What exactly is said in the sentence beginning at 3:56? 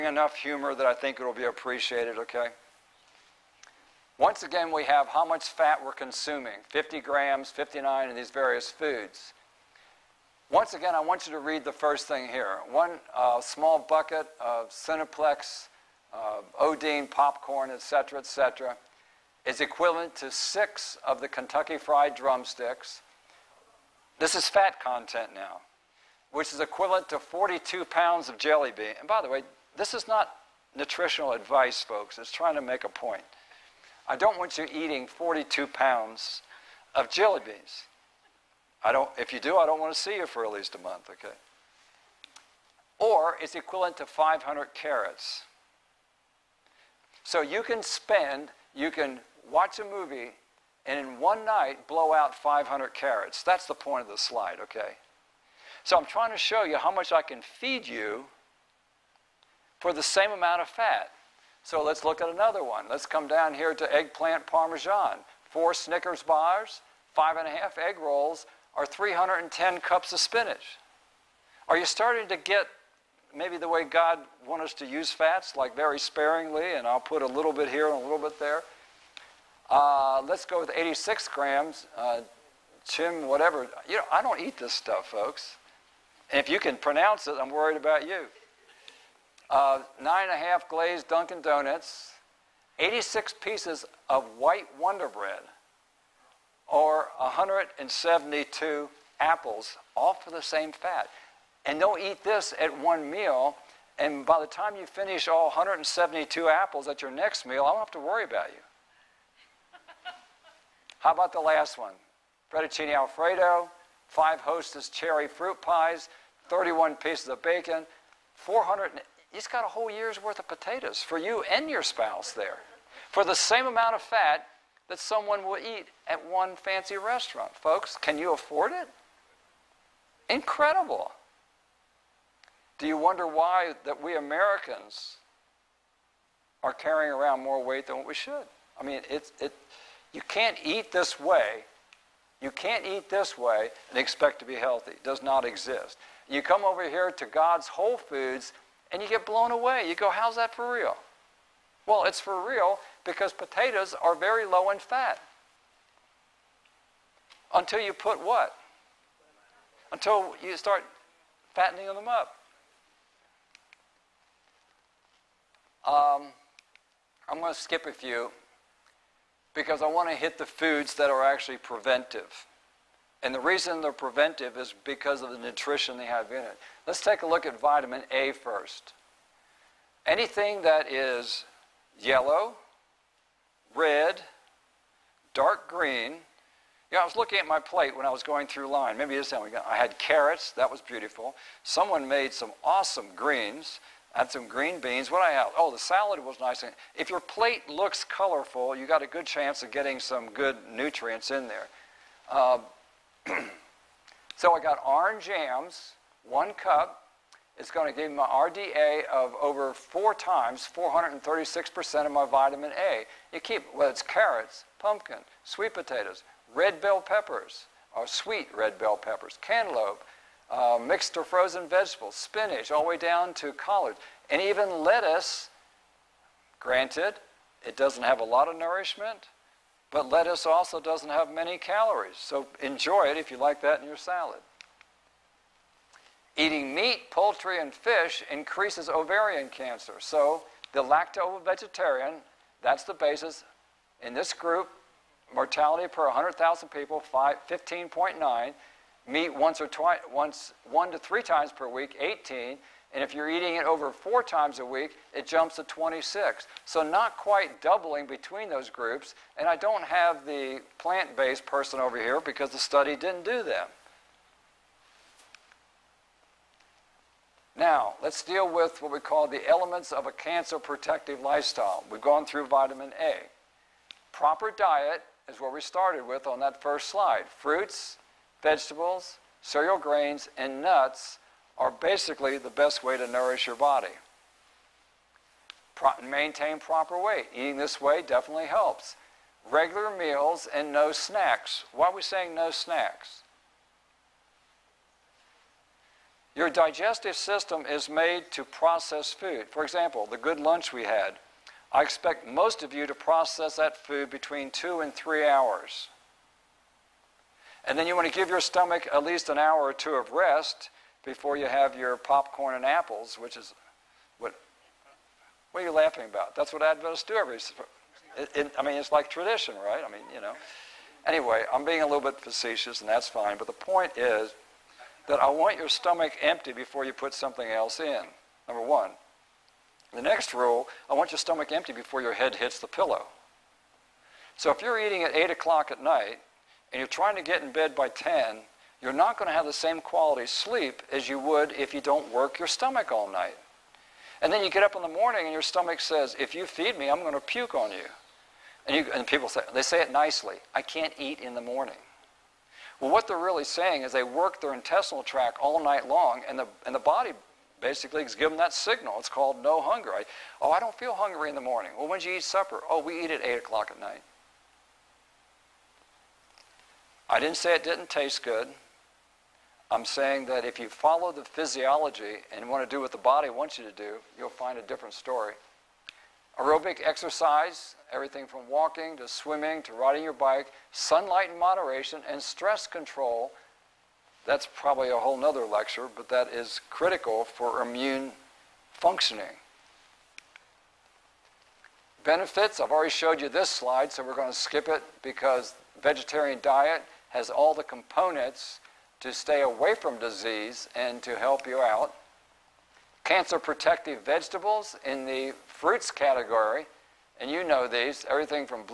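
Eating meat, poultry, and fish increases ovarian cancer.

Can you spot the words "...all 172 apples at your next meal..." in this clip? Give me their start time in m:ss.
1:45.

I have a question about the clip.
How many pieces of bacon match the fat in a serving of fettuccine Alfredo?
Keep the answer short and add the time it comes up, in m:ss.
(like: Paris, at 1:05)
31, at 1:56.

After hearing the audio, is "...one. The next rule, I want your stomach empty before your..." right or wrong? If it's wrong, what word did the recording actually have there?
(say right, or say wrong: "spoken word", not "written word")
right.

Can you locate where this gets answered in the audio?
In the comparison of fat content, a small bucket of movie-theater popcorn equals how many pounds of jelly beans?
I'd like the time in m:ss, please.
0:27.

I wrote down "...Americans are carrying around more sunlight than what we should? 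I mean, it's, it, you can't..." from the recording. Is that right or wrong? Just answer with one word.
wrong.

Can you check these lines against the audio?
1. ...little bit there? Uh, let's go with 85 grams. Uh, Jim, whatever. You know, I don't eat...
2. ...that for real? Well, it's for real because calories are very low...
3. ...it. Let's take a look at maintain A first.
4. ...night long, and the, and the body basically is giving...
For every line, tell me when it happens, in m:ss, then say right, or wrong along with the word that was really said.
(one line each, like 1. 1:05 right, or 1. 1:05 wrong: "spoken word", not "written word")
1. 1:17 wrong: "86", not "85"
2. 2:30 wrong: "potatoes", not "calories"
3. 2:56 wrong: "vitamin", not "maintain"
4. 5:55 right.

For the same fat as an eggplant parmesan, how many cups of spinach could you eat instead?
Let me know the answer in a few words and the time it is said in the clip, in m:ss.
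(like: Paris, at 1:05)
310, at 1:08.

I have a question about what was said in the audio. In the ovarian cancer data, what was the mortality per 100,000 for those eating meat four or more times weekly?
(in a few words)
26.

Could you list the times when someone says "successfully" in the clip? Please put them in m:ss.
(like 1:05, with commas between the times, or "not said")
not said.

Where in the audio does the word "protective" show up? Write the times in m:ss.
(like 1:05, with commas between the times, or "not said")
4:30, 6:43.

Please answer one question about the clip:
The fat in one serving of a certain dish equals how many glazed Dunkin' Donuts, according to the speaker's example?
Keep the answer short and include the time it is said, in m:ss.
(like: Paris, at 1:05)
9 and a half, at 1:30.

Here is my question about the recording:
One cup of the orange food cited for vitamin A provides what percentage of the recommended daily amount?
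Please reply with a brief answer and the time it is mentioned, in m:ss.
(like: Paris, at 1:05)
436%, at 3:30.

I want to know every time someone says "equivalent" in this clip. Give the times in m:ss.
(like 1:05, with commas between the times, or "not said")
0:19, 0:26, 0:43.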